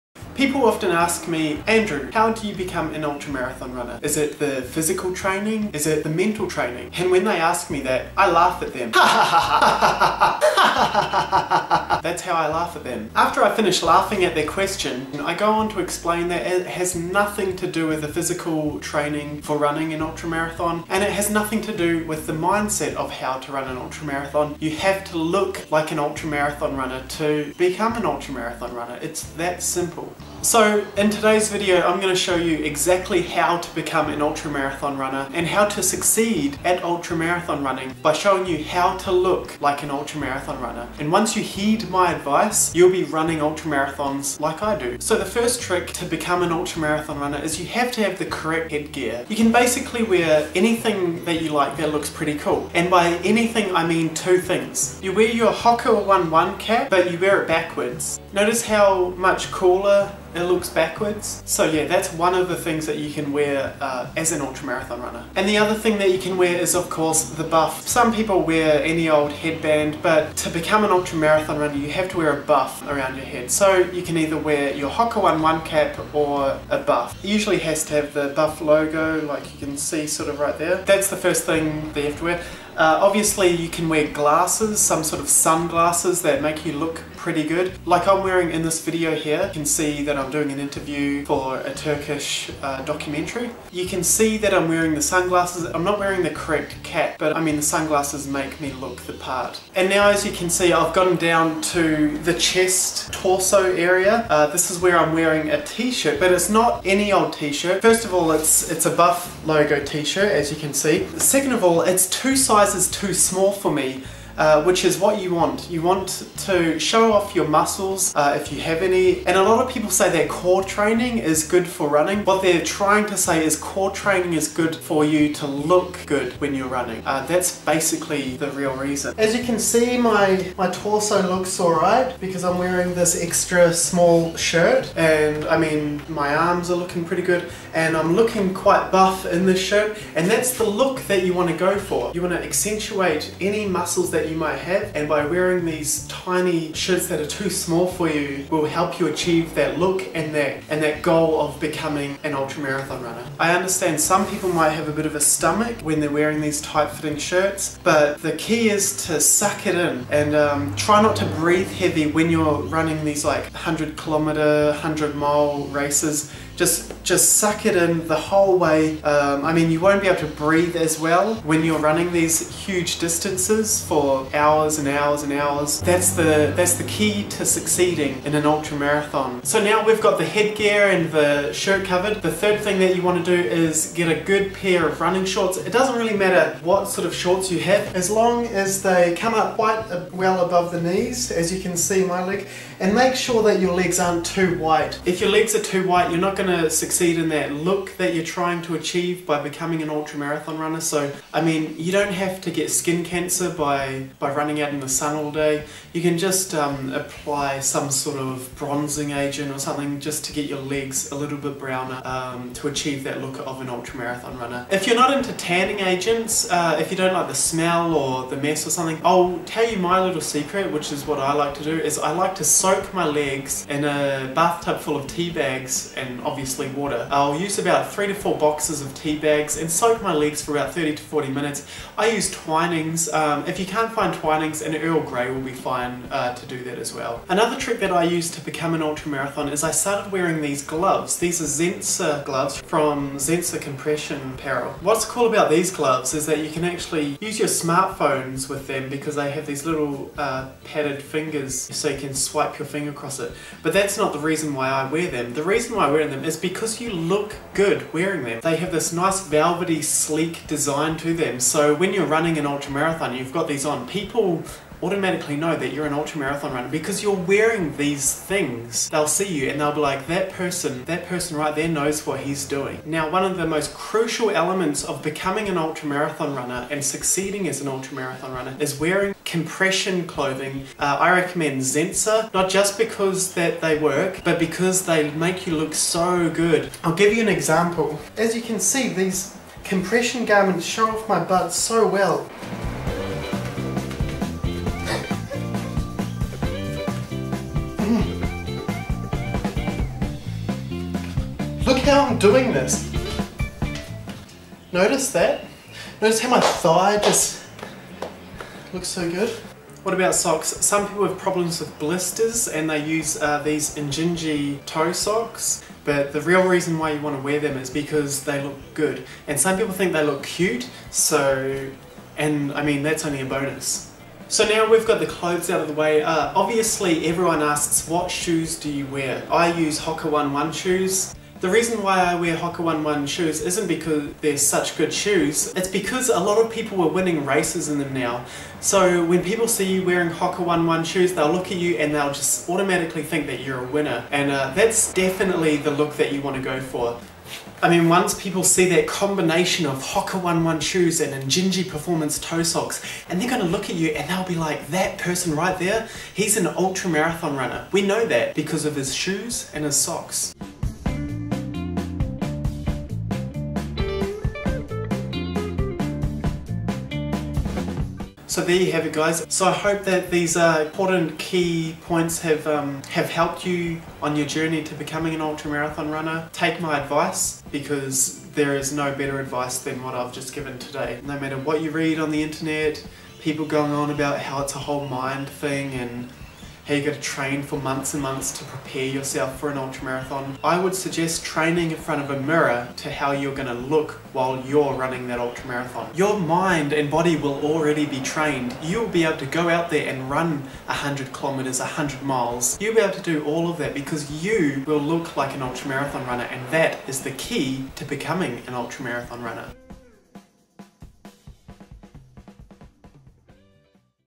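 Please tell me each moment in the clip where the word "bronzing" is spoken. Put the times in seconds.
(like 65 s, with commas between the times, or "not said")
208 s.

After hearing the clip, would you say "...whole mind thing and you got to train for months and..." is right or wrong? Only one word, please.
right.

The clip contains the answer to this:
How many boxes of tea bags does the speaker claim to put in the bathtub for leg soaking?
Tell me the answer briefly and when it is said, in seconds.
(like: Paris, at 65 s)
3 to 4, at 227 s.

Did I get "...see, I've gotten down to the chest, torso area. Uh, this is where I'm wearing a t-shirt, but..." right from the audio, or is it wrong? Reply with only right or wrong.
right.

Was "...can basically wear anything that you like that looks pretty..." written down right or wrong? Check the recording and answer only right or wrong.
right.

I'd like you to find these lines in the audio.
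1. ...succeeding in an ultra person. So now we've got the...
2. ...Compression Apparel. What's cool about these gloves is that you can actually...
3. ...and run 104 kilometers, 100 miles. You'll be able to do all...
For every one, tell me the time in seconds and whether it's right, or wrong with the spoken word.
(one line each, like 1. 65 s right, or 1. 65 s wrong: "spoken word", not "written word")
1. 177 s wrong: "marathon", not "person"
2. 243 s right
3. 399 s wrong: "100", not "104".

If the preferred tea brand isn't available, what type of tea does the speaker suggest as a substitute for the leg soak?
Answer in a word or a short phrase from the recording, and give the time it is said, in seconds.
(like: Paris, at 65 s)
Earl Grey, at 234 s.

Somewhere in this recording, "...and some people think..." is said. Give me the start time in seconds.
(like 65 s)
319 s.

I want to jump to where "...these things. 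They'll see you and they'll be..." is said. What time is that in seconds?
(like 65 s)
267 s.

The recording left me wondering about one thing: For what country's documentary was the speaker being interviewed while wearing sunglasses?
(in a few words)
Turkish.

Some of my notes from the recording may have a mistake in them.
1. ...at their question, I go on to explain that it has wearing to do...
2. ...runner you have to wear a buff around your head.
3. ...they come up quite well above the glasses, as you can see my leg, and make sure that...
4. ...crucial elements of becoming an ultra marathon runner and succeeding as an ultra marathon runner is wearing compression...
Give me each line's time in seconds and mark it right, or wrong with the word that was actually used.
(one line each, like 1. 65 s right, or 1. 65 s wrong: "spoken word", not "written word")
1. 14 s wrong: "nothing", not "wearing"
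2. 71 s right
3. 188 s wrong: "knees", not "glasses"
4. 273 s right.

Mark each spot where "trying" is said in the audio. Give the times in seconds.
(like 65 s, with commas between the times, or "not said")
122 s, 198 s.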